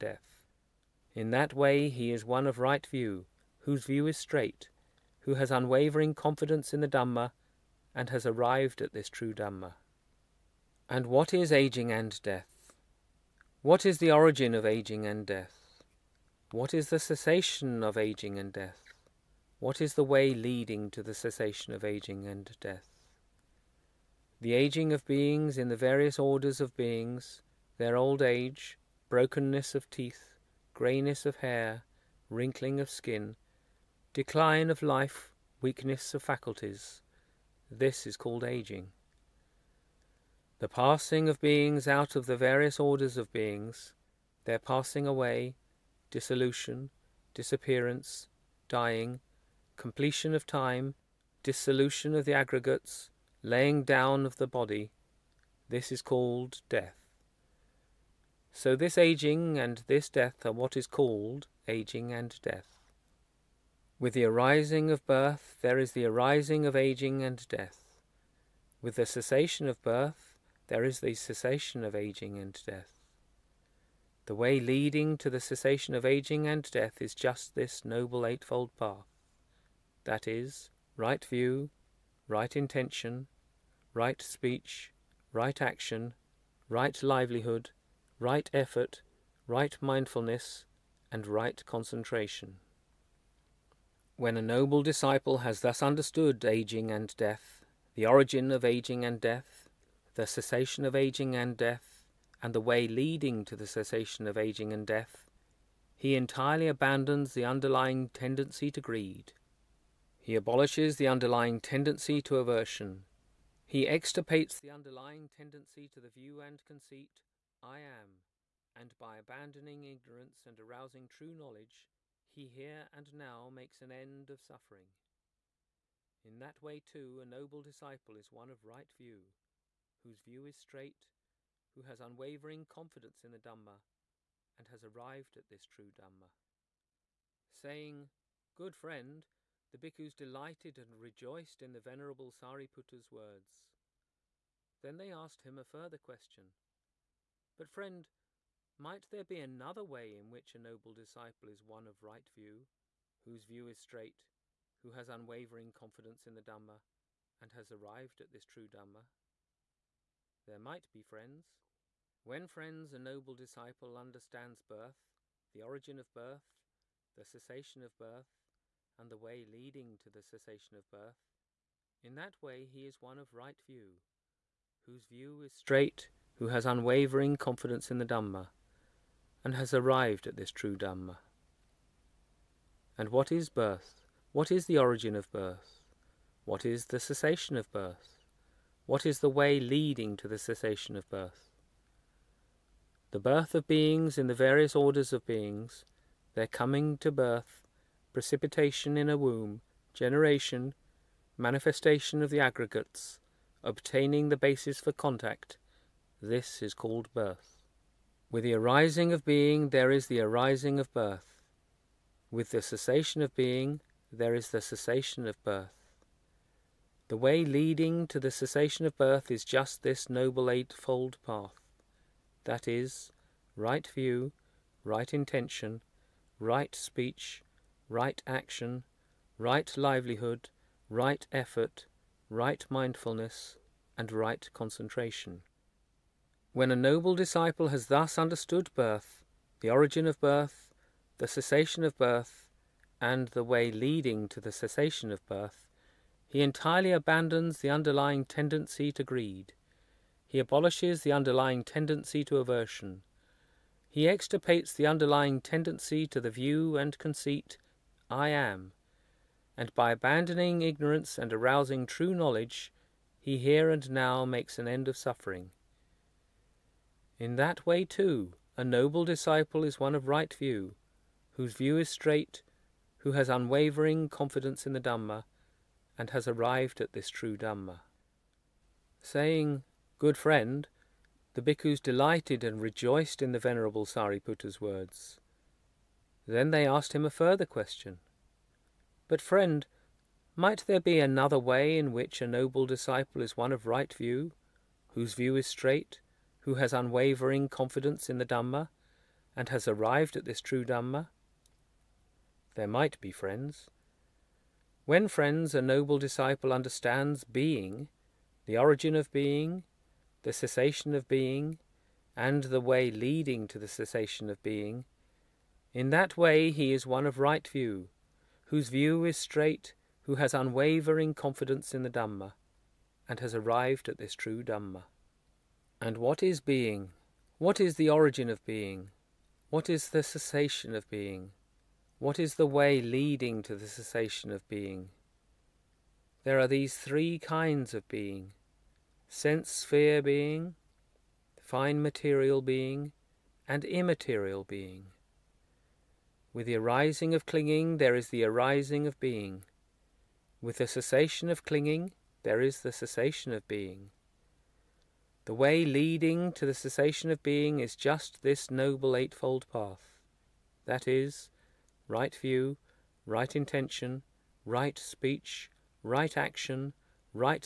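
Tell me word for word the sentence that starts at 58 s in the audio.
So this aging and this death are what is called aging and death.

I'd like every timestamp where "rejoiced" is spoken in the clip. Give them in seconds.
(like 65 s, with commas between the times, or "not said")
140 s, 282 s.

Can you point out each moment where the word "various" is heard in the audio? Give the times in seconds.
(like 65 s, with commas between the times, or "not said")
25 s, 42 s, 194 s.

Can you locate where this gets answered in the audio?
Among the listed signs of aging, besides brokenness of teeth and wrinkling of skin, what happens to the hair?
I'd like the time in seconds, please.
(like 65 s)
30 s.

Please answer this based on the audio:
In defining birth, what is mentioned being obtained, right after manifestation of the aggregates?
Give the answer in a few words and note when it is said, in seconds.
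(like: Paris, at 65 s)
Basis for contact, at 204 s.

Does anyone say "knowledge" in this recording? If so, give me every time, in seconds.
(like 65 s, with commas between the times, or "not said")
121 s, 262 s.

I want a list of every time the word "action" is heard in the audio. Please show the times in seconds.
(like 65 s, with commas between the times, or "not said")
85 s, 228 s, 366 s.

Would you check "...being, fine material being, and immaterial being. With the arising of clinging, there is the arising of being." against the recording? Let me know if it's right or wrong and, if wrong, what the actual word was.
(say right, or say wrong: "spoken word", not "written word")
right.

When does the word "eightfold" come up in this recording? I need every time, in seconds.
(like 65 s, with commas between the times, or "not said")
78 s, 220 s, 358 s.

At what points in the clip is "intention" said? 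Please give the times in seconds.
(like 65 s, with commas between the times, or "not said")
82 s, 225 s, 363 s.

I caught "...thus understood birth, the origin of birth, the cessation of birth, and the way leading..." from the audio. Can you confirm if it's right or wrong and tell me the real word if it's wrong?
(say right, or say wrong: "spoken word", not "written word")
right.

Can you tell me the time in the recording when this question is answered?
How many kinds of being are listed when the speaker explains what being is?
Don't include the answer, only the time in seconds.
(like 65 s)
336 s.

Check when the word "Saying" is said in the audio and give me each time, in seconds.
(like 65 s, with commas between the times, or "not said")
137 s, 279 s.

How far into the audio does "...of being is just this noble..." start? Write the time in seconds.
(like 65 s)
357 s.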